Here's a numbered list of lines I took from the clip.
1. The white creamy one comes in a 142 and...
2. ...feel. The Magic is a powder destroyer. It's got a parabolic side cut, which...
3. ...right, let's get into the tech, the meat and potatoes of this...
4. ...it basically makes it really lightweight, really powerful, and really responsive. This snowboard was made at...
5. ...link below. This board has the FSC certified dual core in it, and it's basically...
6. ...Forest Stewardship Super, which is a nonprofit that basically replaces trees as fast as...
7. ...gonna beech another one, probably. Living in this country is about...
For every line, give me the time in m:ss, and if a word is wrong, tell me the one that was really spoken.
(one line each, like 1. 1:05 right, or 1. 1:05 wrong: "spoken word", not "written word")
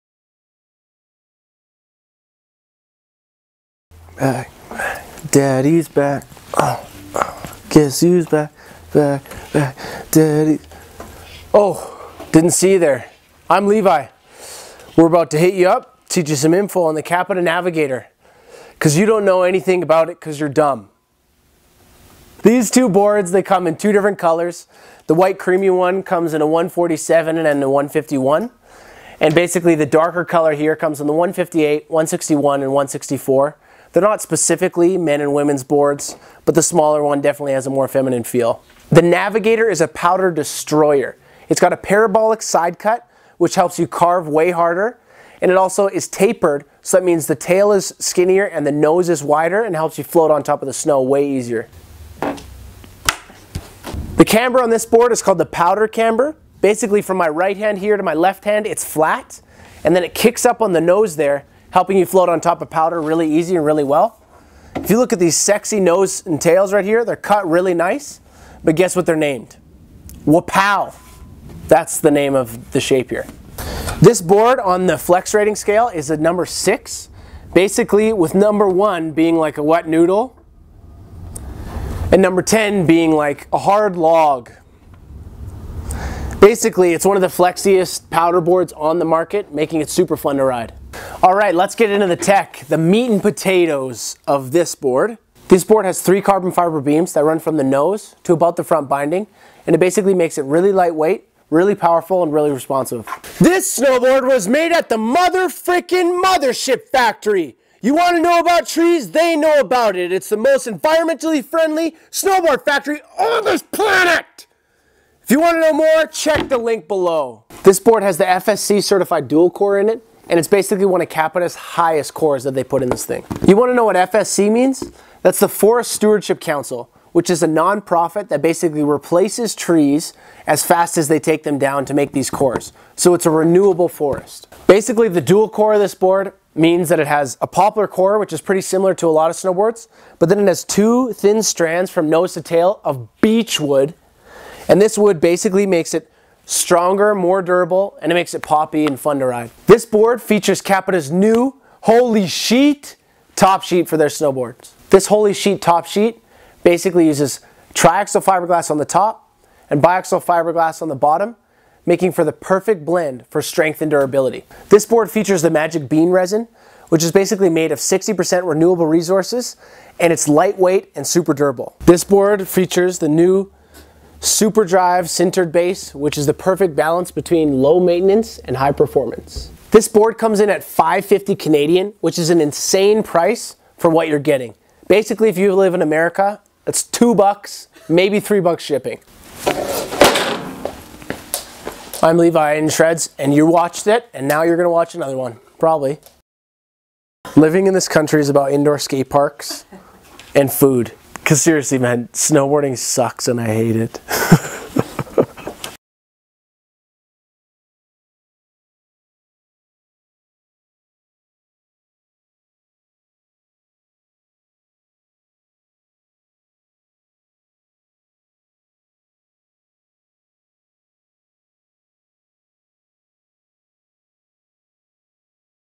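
1. 0:25 wrong: "147", not "142"
2. 0:38 wrong: "Navigator", not "Magic"
3. 1:31 right
4. 1:39 right
5. 1:56 right
6. 2:05 wrong: "Council", not "Super"
7. 3:14 wrong: "watch", not "beech".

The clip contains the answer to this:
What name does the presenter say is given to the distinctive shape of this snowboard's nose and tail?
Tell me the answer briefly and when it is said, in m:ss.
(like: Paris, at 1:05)
Wapow, at 1:10.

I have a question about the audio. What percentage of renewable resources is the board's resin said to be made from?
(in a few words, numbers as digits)
60%.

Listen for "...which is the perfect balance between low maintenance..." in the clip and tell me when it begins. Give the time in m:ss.
2:55.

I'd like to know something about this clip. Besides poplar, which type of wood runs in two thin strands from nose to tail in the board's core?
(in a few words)
Beech.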